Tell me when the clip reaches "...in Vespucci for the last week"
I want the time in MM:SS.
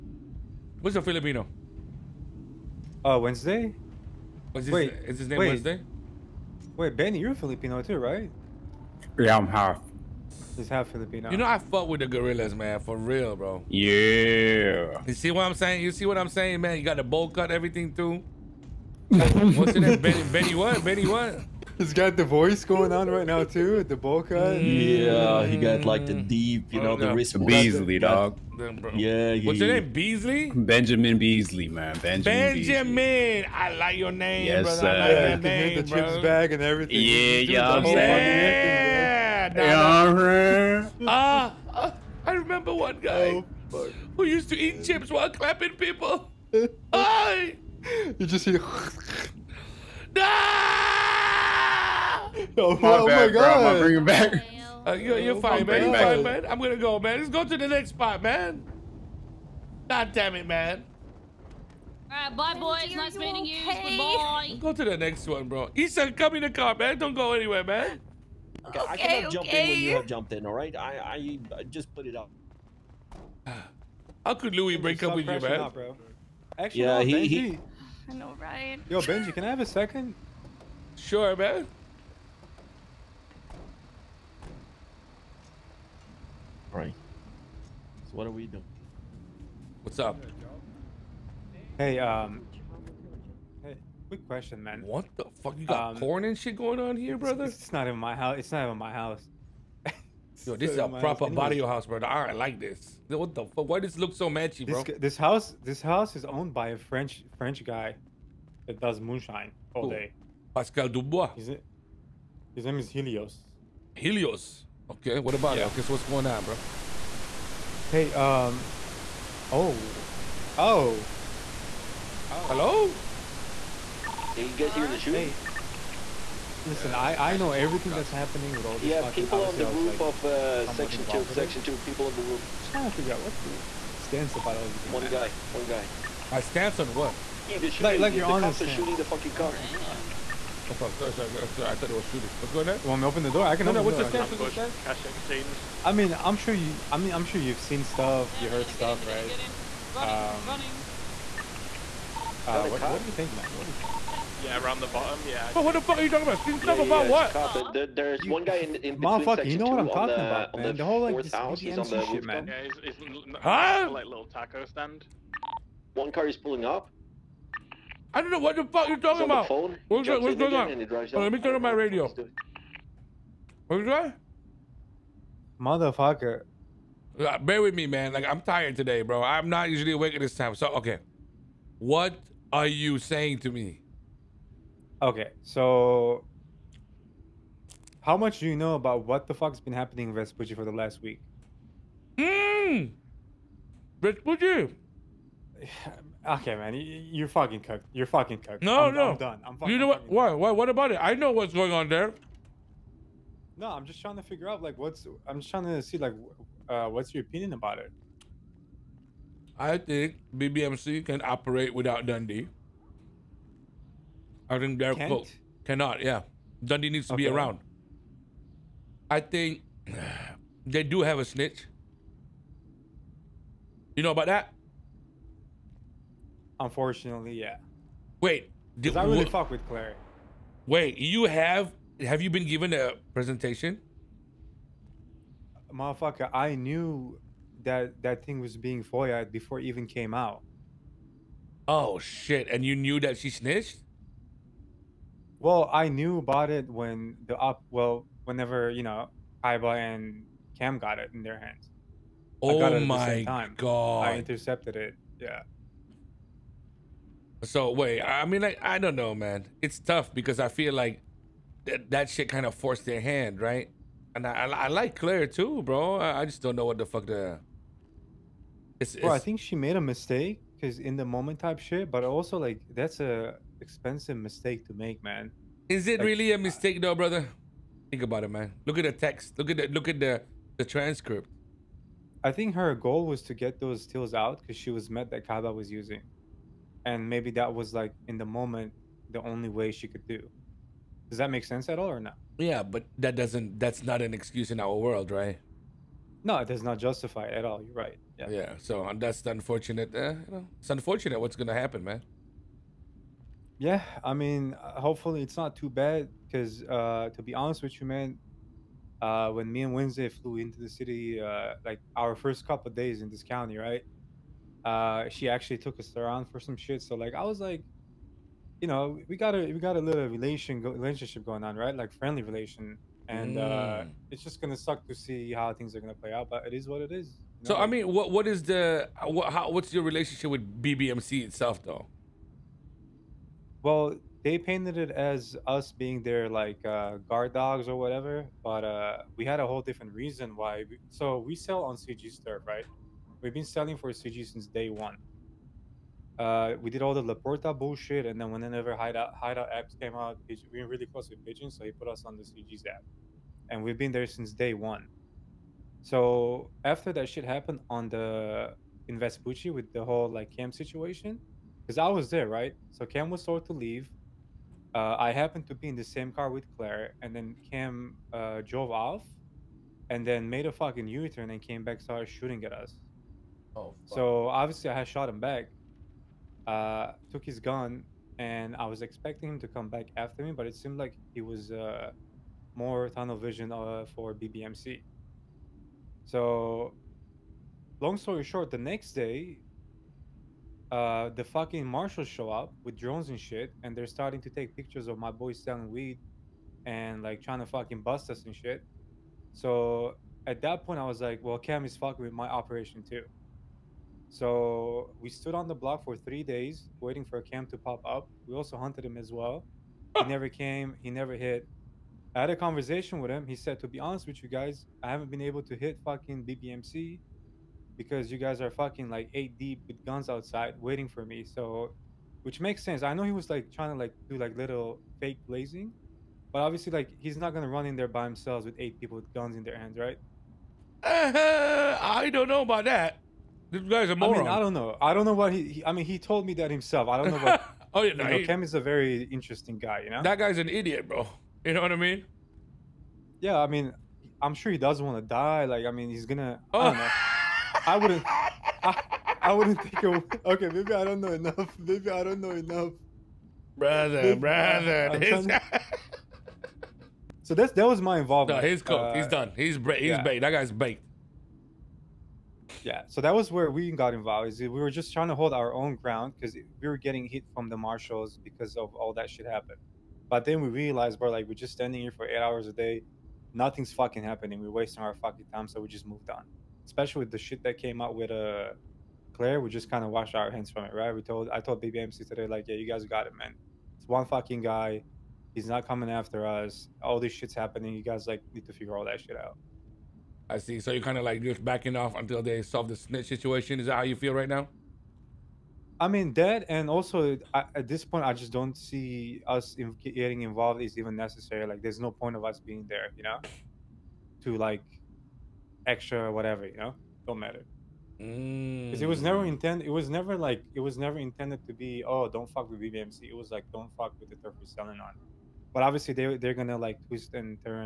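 03:10.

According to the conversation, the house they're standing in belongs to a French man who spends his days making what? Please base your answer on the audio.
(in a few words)
moonshine.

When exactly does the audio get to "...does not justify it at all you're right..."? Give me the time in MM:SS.
04:56.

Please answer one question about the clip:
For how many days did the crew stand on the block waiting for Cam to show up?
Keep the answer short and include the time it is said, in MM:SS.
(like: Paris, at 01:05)
3, at 06:45.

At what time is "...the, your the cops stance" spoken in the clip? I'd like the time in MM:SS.
02:18.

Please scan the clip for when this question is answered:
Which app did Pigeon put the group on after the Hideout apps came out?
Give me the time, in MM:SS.
05:52.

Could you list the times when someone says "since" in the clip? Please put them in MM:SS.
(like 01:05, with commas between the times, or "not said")
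05:44, 05:54.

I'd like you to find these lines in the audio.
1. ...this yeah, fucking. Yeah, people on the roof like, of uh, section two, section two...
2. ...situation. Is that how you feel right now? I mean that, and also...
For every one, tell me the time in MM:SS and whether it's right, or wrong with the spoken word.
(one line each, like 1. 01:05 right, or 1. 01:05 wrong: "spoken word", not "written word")
1. 02:08 right
2. 08:13 right.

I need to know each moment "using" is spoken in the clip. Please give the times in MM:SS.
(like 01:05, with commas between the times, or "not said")
04:45.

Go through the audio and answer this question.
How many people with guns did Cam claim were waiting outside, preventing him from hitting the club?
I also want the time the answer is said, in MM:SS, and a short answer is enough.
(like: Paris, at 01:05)
8, at 06:59.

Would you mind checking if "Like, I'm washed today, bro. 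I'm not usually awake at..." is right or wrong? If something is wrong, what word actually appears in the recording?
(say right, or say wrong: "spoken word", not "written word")
wrong: "tired", not "washed".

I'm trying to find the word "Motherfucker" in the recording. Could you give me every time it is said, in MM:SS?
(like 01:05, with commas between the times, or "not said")
02:38, 02:55, 03:55.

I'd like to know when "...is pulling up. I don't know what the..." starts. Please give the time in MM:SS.
02:46.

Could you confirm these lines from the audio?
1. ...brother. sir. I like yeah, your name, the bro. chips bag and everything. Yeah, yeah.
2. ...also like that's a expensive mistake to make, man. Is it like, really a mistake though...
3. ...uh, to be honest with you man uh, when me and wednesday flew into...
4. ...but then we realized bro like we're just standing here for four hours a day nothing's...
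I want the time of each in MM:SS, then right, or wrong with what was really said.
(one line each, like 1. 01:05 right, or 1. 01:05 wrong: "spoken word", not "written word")
1. 00:34 right
2. 04:32 right
3. 05:06 right
4. 07:50 wrong: "eight", not "four".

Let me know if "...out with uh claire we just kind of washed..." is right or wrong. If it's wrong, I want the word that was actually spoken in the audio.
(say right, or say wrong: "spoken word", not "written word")
right.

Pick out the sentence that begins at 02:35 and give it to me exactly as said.
But what the fuck are you talking about?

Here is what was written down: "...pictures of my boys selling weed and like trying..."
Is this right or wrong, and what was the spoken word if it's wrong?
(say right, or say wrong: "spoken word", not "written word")
right.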